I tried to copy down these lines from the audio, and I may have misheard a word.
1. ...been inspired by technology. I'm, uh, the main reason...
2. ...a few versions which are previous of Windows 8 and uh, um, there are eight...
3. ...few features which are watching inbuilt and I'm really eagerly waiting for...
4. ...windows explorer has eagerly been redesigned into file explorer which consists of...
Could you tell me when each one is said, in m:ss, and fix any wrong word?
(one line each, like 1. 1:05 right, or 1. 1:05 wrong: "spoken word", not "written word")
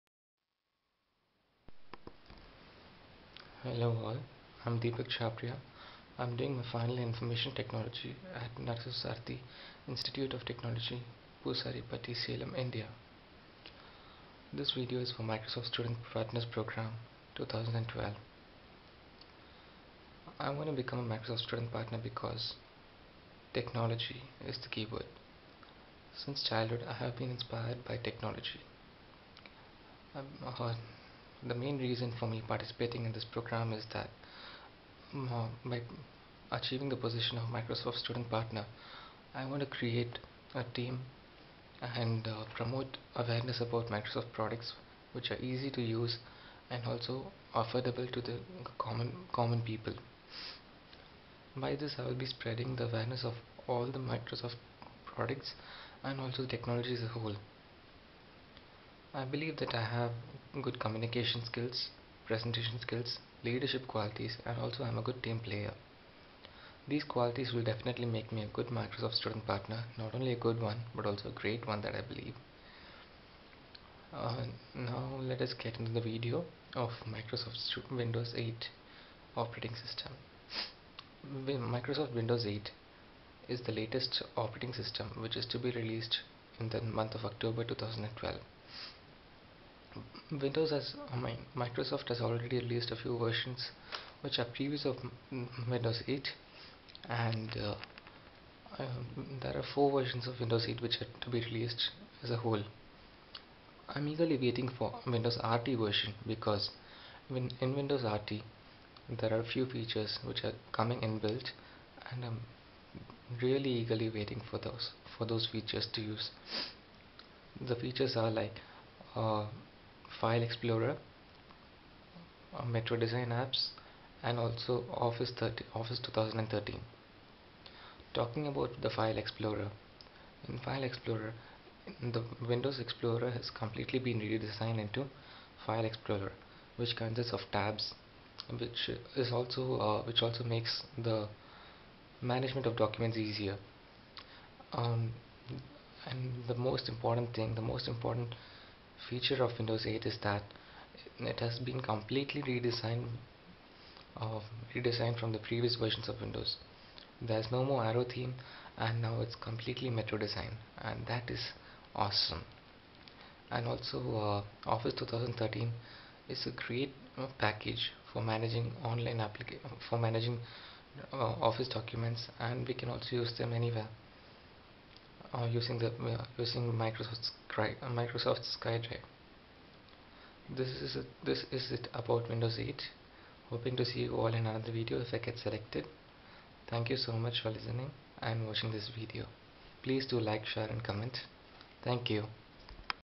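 1. 0:27 right
2. 1:32 wrong: "four", not "eight"
3. 1:49 wrong: "coming", not "watching"
4. 2:12 wrong: "completely", not "eagerly".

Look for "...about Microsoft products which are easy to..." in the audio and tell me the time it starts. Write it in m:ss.
0:43.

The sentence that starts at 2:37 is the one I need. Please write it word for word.
There's no more Aero theme and now it's completely metro design and that is awesome.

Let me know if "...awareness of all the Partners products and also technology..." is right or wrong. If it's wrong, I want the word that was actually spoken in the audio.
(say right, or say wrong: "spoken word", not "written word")
wrong: "Microsoft", not "Partners".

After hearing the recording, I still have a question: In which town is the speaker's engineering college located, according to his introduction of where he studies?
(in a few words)
Poosaripatti.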